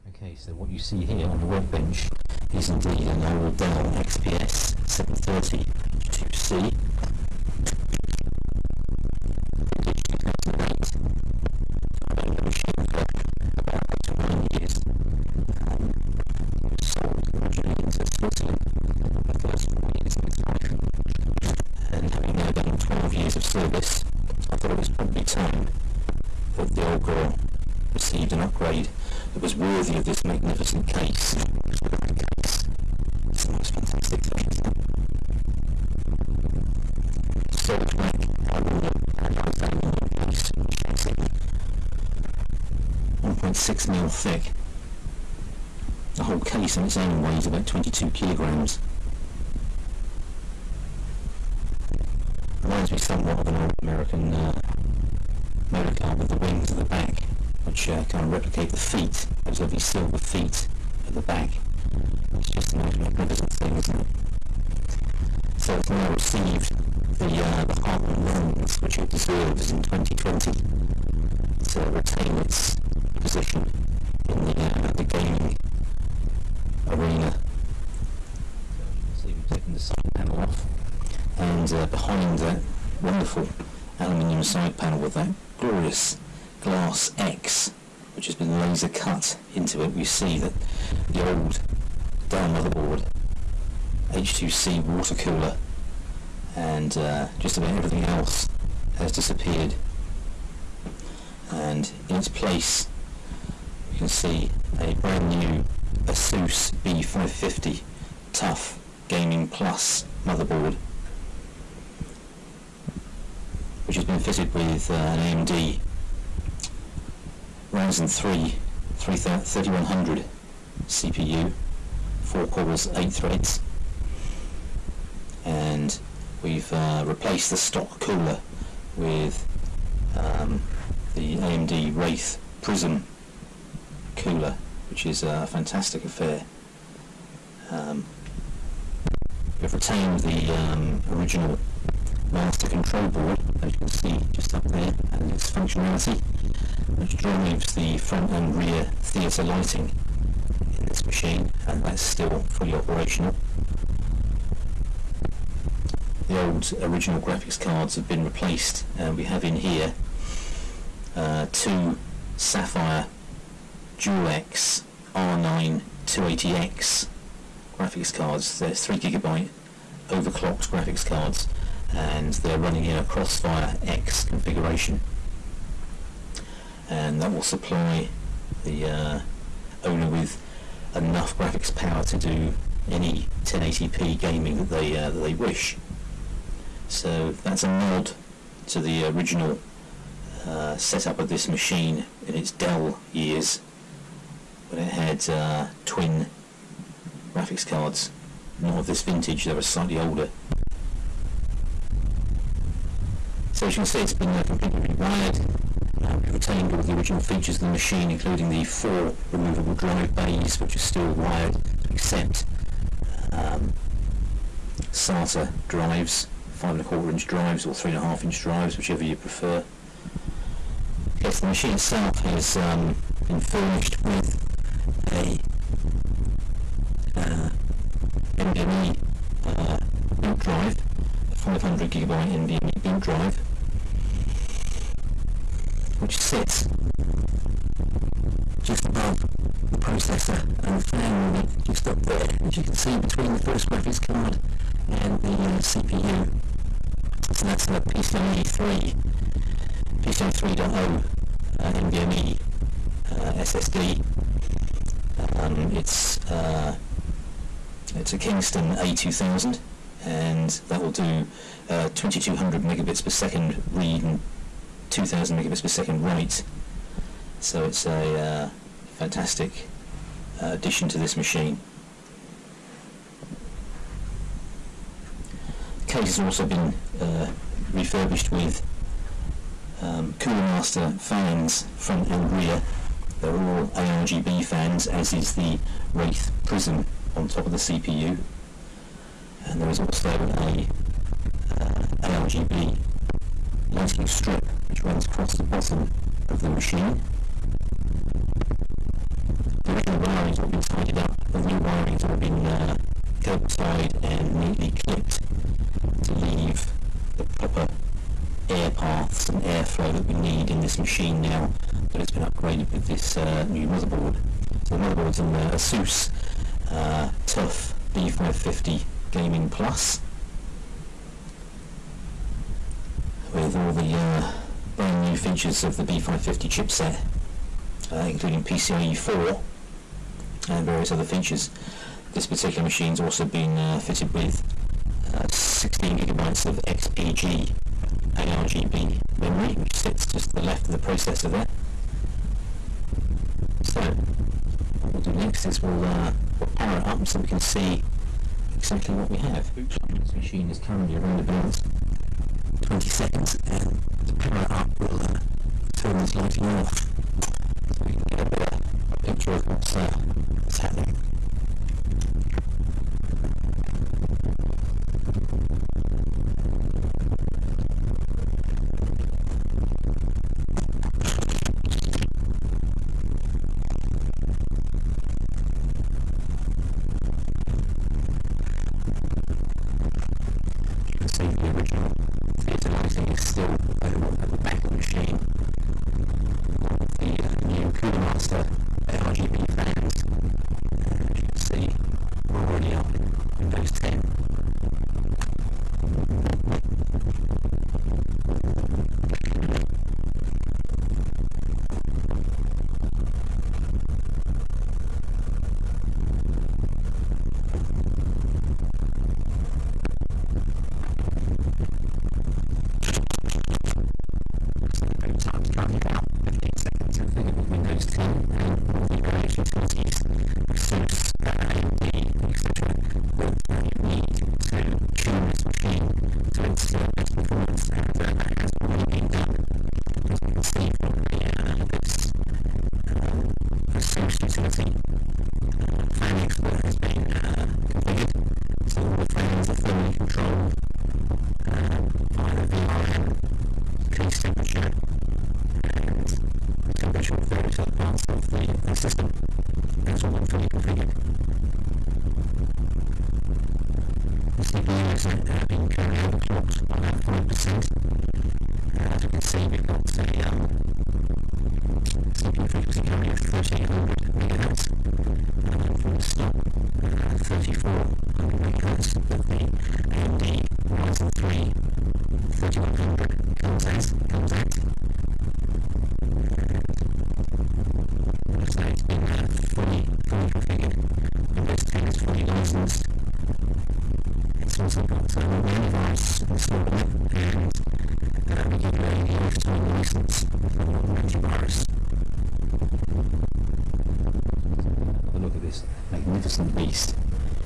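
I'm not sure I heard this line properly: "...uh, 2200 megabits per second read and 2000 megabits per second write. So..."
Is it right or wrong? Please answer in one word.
right.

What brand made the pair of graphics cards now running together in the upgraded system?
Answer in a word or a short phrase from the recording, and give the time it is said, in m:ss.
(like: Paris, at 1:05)
Sapphire, at 2:42.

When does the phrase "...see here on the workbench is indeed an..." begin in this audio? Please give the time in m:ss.
0:00.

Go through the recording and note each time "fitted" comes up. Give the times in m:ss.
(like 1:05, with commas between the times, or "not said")
1:54, 5:33.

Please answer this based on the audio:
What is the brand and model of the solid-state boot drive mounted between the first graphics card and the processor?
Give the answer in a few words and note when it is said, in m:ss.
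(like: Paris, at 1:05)
Kingston A2000, at 4:18.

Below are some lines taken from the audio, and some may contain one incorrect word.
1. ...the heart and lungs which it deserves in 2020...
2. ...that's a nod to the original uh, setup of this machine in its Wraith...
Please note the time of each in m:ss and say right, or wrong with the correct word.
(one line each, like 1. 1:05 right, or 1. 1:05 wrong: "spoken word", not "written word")
1. 1:07 right
2. 3:07 wrong: "Dell", not "Wraith".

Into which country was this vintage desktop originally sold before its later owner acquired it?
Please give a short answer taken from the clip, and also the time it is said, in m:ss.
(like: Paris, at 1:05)
Switzerland, at 0:18.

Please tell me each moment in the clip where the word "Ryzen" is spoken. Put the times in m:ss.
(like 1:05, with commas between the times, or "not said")
1:57, 7:50.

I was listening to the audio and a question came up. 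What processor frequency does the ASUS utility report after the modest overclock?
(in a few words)
3800 MHz.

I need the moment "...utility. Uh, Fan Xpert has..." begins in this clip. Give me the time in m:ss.
7:14.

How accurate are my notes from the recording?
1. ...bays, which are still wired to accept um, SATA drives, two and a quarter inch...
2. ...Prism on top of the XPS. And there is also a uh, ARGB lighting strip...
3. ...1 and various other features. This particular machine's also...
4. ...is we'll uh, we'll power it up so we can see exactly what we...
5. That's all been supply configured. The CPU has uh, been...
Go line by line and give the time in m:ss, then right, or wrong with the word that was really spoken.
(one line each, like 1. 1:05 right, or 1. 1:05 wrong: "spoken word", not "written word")
1. 3:30 wrong: "five", not "two"
2. 4:46 wrong: "CPU", not "XPS"
3. 5:28 wrong: "4", not "1"
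4. 5:45 right
5. 7:29 wrong: "fully", not "supply".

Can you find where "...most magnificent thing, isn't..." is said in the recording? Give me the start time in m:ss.
1:02.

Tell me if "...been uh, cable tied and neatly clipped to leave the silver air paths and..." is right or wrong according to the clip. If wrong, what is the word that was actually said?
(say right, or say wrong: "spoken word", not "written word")
wrong: "proper", not "silver".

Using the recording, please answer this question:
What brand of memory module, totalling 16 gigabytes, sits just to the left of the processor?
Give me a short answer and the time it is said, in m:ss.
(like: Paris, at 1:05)
XPG, at 5:36.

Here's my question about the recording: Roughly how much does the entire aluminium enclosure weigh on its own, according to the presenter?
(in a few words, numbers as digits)
22 kilograms.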